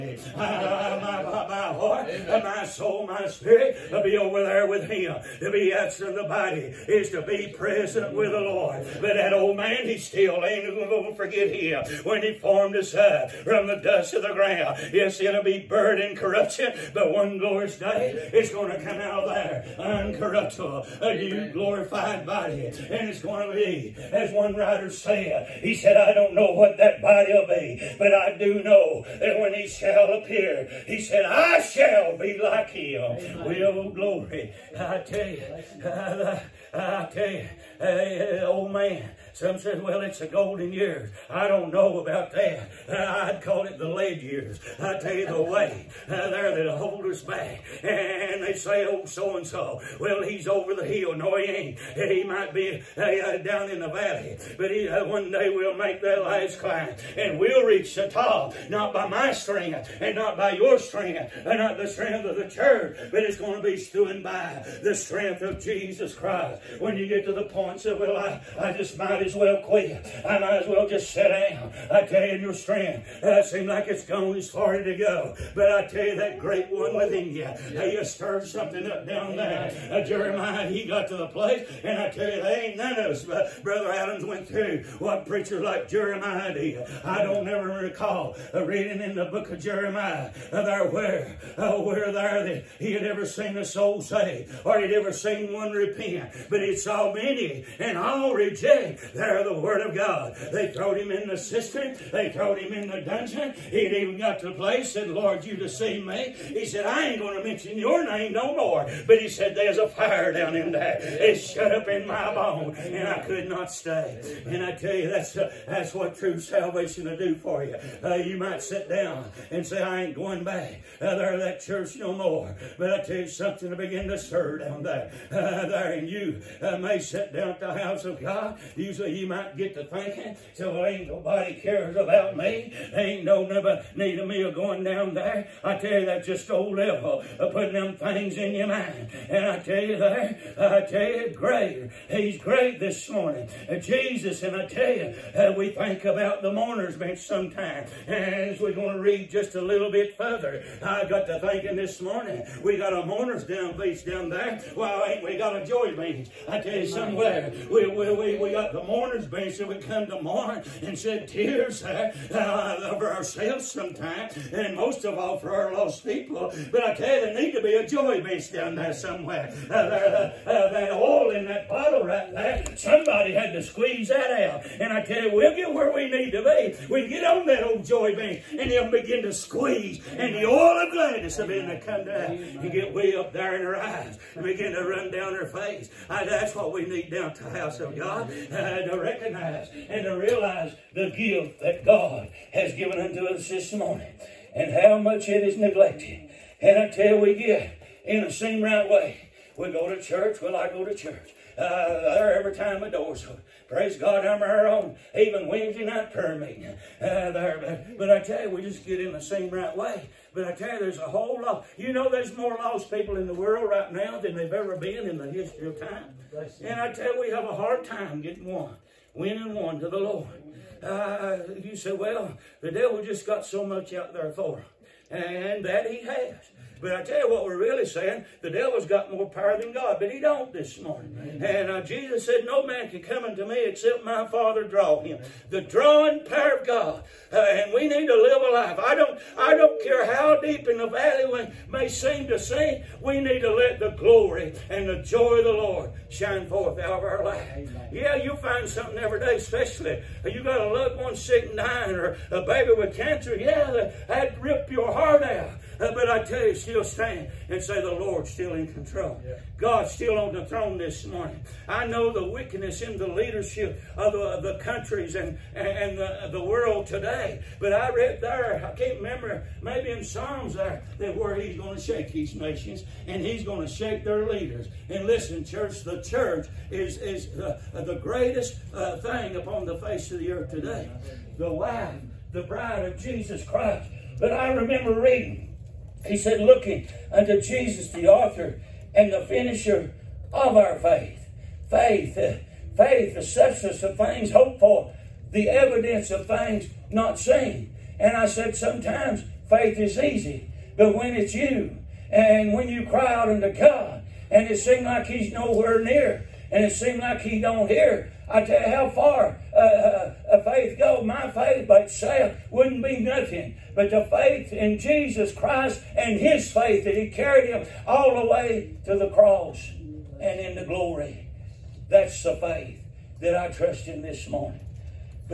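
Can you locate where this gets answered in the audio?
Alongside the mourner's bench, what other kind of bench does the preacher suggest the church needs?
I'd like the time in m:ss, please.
2:35.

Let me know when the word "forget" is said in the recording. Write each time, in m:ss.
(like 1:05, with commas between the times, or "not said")
0:11.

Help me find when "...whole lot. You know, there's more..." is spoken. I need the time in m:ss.
3:31.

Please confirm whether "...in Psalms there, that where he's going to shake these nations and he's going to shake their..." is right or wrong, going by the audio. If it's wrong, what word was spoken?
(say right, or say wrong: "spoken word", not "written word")
right.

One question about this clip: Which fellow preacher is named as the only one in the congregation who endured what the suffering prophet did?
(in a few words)
Brother Adams.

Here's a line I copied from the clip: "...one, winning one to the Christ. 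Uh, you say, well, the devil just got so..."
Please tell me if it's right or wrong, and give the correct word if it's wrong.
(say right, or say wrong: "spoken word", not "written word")
wrong: "Lord", not "Christ".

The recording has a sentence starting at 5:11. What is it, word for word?
My faith by itself wouldn't be nothing.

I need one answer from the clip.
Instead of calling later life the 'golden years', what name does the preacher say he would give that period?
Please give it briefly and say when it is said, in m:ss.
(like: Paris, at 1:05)
the lead years, at 0:43.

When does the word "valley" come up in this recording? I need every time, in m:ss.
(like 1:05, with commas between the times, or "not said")
0:53, 4:00.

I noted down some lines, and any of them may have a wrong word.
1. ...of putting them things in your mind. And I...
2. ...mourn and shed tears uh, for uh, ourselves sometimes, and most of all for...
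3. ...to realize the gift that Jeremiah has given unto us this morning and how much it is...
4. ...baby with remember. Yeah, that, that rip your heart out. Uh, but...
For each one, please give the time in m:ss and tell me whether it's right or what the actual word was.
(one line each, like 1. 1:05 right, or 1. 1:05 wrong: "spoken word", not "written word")
1. 2:17 right
2. 2:40 right
3. 3:10 wrong: "God", not "Jeremiah"
4. 4:12 wrong: "cancer", not "remember".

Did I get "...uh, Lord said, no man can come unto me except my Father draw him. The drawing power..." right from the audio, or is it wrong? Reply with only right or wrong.
wrong.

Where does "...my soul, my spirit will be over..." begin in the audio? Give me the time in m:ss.
0:02.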